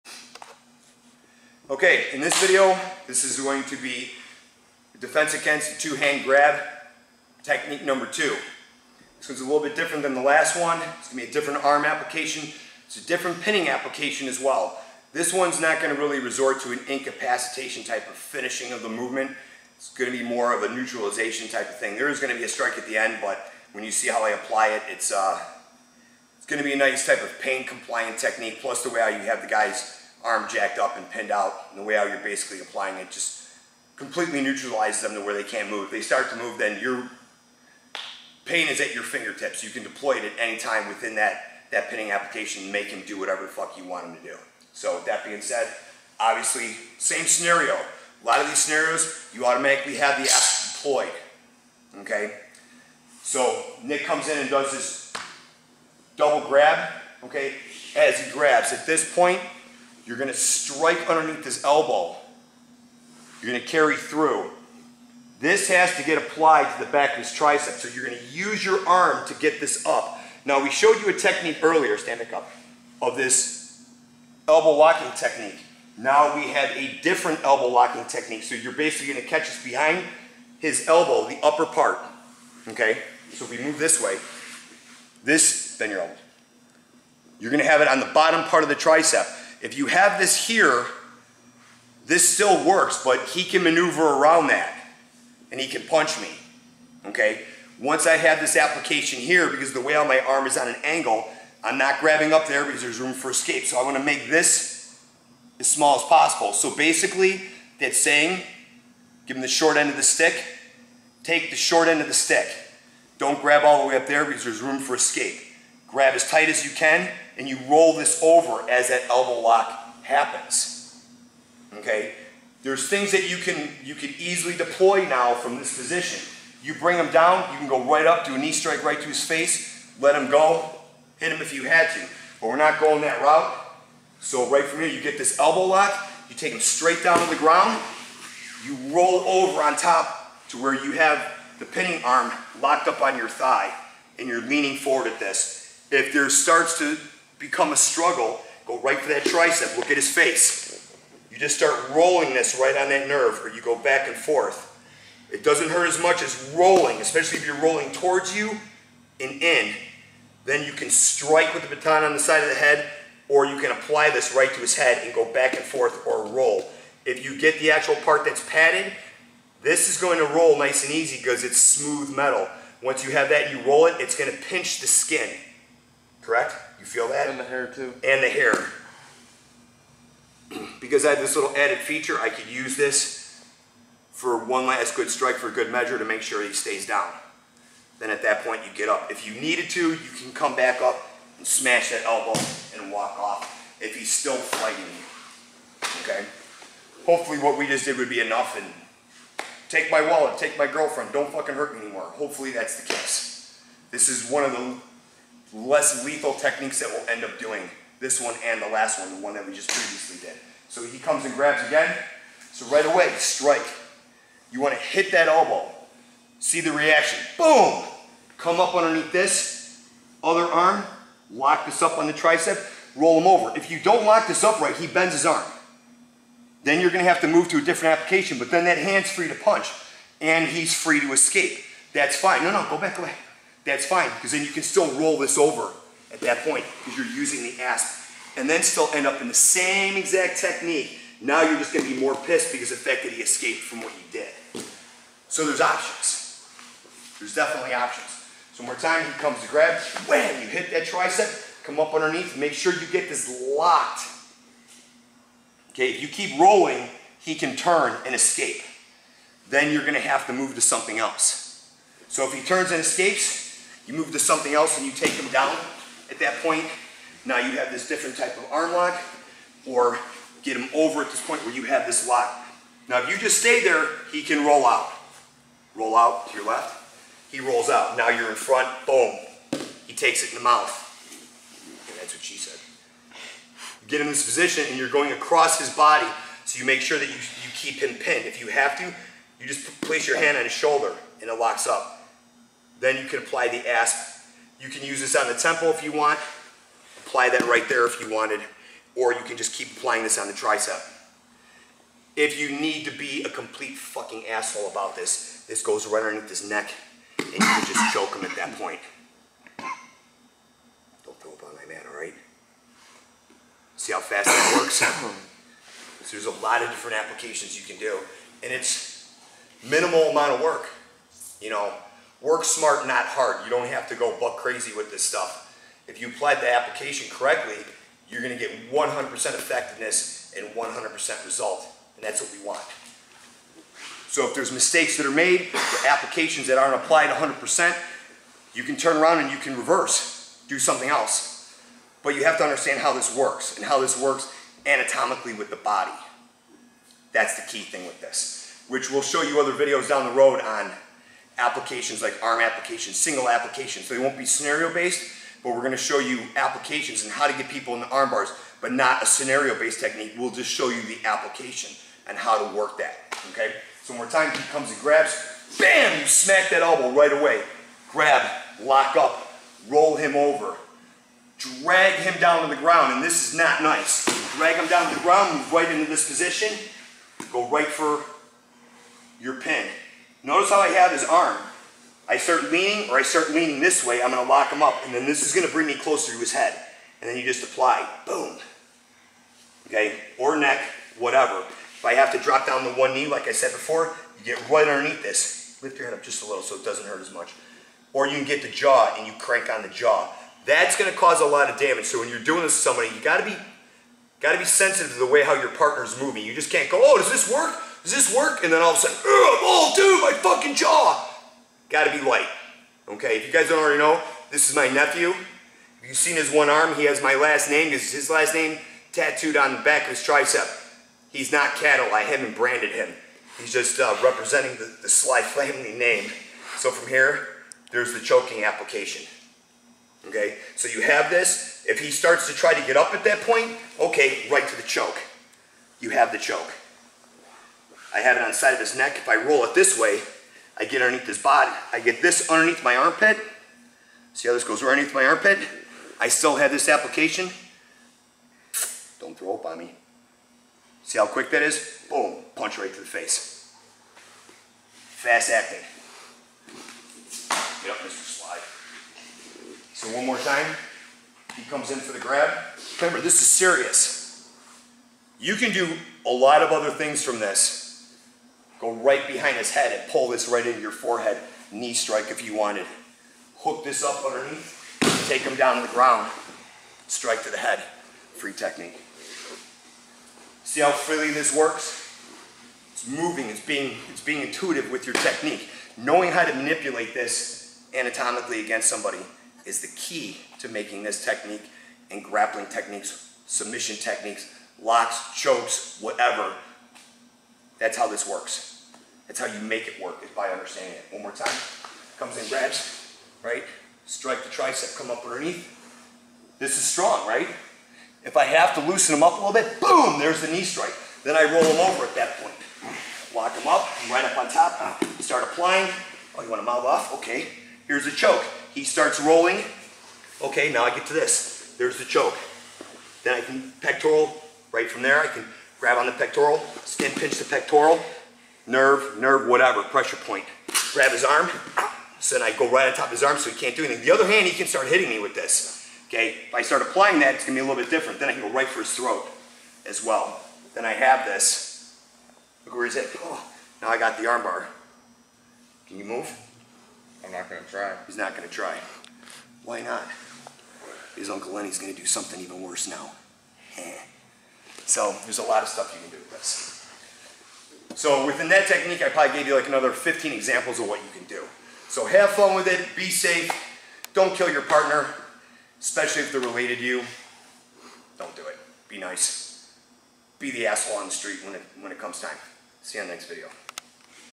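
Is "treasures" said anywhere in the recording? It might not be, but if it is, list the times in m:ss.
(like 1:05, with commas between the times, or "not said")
not said.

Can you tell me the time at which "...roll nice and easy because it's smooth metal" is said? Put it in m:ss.
2:50.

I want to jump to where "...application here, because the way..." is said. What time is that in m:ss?
1:38.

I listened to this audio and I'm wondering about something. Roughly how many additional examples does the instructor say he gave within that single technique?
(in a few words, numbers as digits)
15.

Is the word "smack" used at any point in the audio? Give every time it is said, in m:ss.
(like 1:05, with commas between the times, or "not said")
6:06.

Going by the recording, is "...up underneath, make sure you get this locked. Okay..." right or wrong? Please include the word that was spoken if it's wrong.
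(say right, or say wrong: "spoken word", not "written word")
right.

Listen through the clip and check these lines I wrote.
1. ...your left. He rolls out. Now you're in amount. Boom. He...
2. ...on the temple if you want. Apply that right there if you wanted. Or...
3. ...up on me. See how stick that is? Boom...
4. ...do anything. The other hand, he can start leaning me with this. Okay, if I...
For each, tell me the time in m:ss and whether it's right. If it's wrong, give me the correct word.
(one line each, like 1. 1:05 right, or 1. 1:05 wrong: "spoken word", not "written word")
1. 4:36 wrong: "front", not "amount"
2. 4:55 right
3. 7:29 wrong: "quick", not "stick"
4. 8:53 wrong: "hitting", not "leaning".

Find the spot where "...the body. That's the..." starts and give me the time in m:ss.
5:45.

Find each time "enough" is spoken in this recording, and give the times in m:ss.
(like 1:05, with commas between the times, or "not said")
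3:18.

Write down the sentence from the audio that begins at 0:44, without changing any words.
So that being said, obviously, same scenario.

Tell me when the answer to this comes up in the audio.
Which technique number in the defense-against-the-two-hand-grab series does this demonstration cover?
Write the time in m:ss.
0:07.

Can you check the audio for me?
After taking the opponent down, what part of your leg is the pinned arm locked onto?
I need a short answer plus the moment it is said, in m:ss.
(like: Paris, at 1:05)
thigh, at 2:23.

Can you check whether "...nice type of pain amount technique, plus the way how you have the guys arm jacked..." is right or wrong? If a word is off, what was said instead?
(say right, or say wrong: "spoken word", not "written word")
wrong: "compliant", not "amount".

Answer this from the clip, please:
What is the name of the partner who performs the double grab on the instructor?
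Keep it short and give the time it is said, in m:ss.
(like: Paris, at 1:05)
Nick, at 0:53.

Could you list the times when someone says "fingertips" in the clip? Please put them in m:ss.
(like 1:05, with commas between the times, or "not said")
0:39.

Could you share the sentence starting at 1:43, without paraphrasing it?
So I wanna make this as small as possible.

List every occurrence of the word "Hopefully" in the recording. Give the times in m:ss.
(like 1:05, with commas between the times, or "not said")
3:17, 3:22.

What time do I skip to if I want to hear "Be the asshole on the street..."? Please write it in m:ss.
9:30.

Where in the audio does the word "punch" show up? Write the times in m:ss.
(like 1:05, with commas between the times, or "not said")
1:35, 3:49, 7:32.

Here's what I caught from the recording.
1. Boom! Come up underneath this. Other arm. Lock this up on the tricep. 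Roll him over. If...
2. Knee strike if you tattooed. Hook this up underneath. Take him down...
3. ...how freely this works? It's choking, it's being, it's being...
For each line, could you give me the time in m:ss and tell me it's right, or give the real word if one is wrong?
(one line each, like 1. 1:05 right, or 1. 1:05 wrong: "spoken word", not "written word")
1. 3:37 right
2. 7:51 wrong: "wanted", not "tattooed"
3. 8:00 wrong: "moving", not "choking".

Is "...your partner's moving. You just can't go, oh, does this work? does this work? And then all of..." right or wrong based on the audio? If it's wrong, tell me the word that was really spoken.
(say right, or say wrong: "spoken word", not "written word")
right.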